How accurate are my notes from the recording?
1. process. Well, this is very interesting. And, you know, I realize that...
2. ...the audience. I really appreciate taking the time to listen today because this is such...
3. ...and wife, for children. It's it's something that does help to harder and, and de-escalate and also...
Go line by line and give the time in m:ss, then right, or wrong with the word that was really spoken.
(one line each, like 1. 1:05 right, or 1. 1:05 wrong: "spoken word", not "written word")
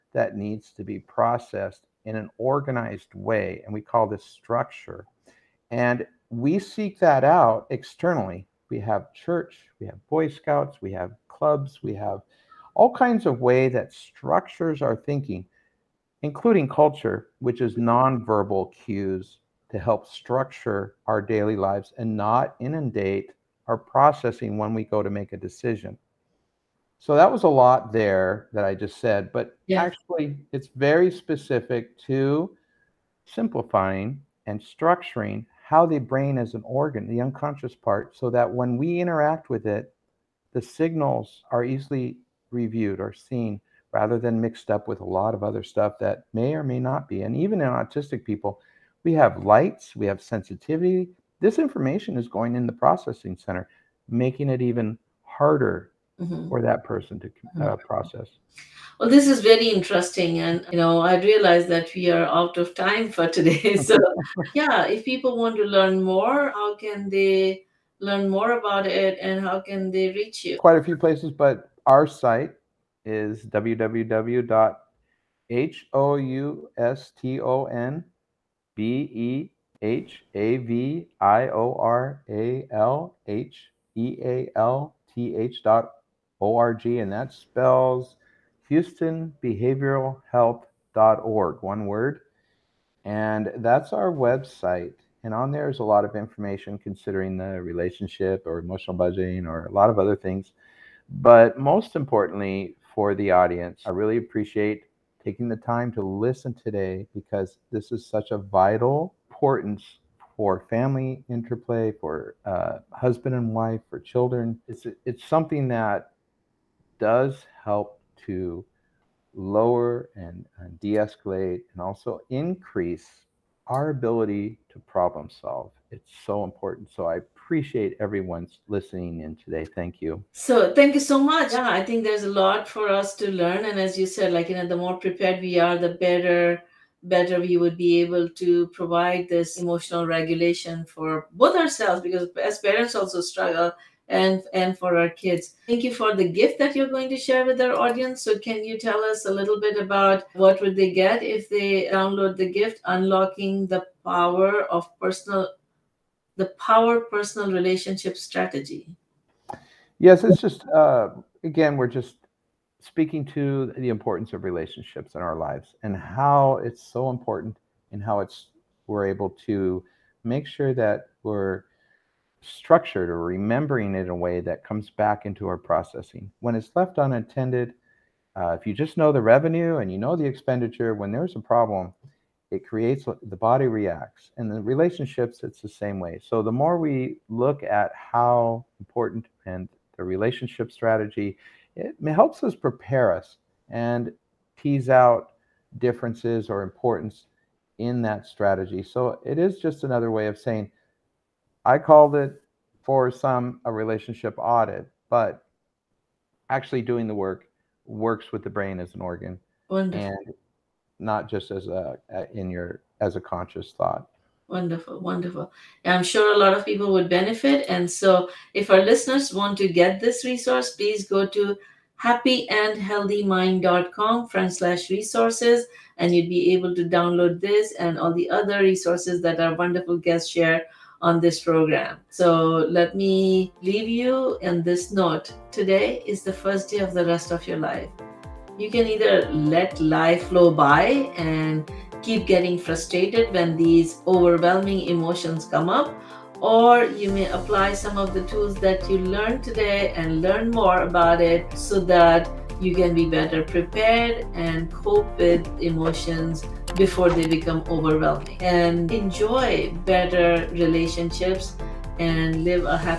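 1. 0:57 right
2. 1:43 right
3. 1:53 wrong: "lower", not "harder".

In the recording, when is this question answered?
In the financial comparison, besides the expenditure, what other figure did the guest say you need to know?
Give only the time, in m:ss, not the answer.
2:59.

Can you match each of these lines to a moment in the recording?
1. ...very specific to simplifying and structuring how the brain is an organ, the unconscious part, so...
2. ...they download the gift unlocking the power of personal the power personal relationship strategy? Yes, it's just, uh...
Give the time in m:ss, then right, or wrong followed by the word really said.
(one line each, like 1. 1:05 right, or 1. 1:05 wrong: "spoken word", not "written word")
1. 0:30 right
2. 2:31 right.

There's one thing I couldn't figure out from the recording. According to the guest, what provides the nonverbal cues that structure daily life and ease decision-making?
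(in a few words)
Culture.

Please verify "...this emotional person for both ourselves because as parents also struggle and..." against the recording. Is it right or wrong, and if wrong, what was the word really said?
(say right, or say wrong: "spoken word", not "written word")
wrong: "regulation", not "person".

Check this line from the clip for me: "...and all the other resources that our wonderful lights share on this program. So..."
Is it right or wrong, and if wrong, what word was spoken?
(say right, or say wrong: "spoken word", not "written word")
wrong: "guests", not "lights".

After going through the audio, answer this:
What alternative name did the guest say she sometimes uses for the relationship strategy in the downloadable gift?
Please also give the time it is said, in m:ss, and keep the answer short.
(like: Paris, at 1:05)
Relationship audit, at 3:23.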